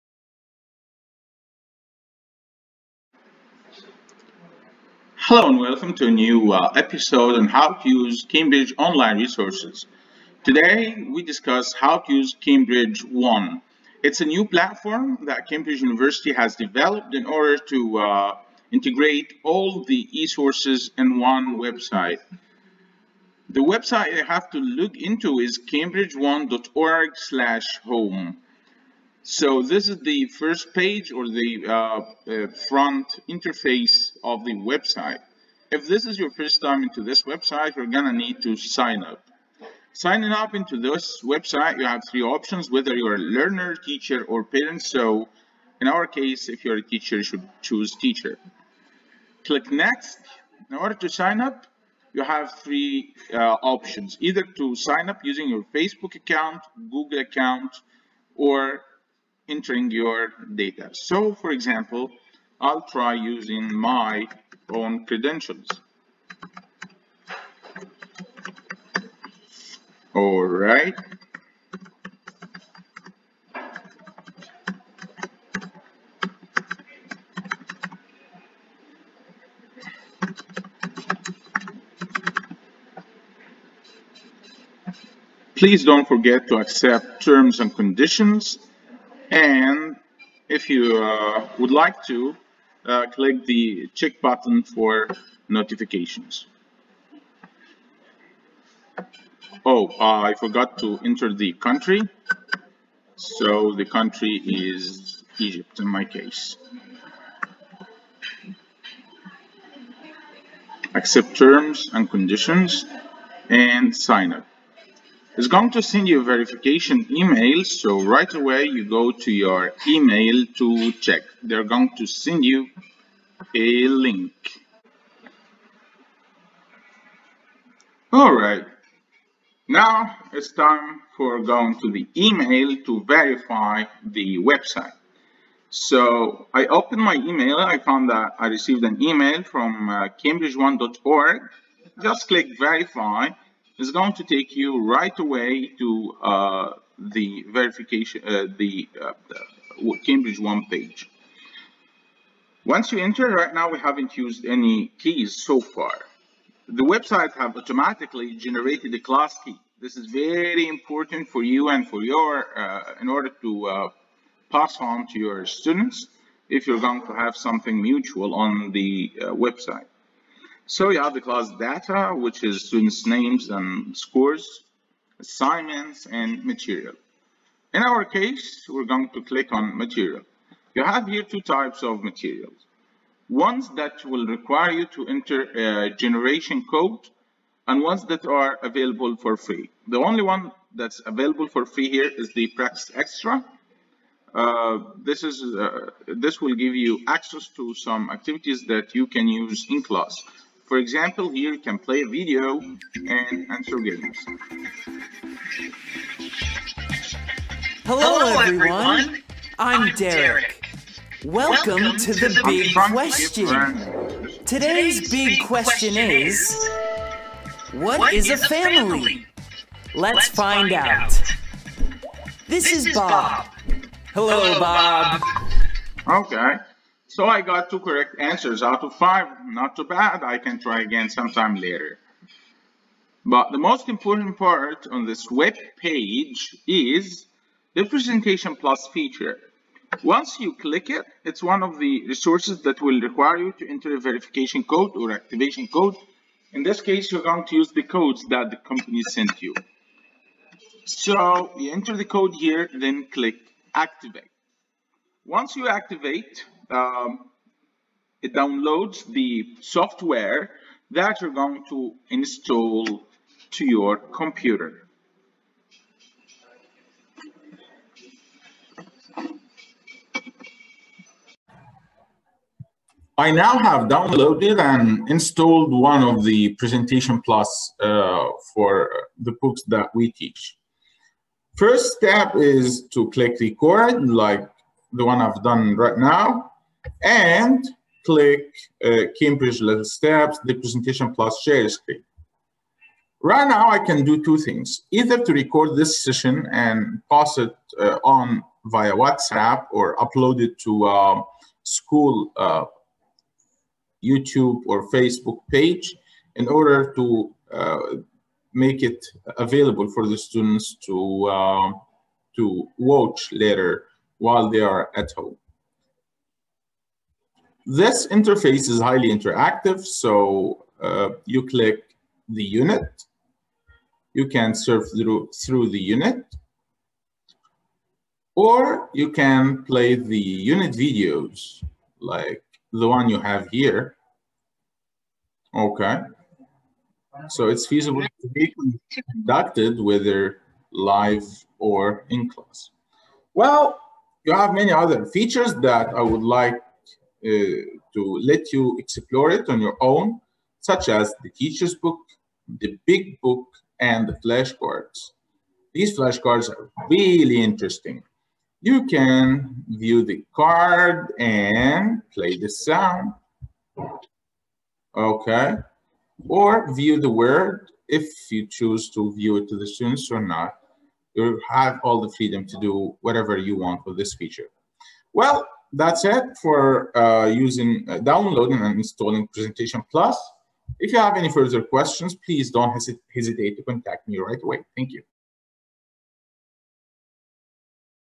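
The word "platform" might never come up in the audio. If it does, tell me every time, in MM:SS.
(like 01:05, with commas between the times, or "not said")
00:14.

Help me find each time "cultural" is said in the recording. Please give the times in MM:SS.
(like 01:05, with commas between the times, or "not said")
not said.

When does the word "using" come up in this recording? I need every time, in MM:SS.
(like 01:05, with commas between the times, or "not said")
00:55, 01:03, 06:17.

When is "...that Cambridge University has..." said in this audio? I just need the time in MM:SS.
00:15.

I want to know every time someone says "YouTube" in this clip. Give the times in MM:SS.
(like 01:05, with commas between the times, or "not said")
05:04.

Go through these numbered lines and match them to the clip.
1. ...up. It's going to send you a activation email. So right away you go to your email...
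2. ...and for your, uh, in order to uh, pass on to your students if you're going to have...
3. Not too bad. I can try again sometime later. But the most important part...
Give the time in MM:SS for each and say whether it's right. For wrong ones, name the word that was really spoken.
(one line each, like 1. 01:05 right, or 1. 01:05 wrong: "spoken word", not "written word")
1. 01:54 wrong: "verification", not "activation"
2. 02:41 right
3. 03:49 right.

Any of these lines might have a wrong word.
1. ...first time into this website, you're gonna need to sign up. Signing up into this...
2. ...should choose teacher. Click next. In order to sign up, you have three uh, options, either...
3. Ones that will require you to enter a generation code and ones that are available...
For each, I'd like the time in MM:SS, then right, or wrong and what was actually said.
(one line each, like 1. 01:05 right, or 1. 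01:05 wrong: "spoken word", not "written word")
1. 00:36 right
2. 00:47 right
3. 03:03 right.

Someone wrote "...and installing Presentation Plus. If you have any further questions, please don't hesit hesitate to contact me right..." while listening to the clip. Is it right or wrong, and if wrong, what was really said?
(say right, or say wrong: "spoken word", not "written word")
right.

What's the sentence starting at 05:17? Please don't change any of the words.
This interface is highly interactive, so uh, you click the unit.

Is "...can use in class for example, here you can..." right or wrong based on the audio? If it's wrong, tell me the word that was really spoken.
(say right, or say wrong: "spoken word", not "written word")
right.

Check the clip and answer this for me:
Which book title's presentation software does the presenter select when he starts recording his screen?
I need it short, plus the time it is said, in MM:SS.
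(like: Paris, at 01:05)
Cambridge Little Steps, at 04:49.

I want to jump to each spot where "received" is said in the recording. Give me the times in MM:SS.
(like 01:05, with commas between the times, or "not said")
02:18.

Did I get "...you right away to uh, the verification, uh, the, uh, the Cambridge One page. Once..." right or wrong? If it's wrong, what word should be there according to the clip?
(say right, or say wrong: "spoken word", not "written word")
right.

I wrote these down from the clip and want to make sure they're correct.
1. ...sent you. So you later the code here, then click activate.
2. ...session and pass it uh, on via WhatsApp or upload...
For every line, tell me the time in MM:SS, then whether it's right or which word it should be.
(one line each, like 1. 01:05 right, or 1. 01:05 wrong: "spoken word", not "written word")
1. 04:09 wrong: "enter", not "later"
2. 04:56 right.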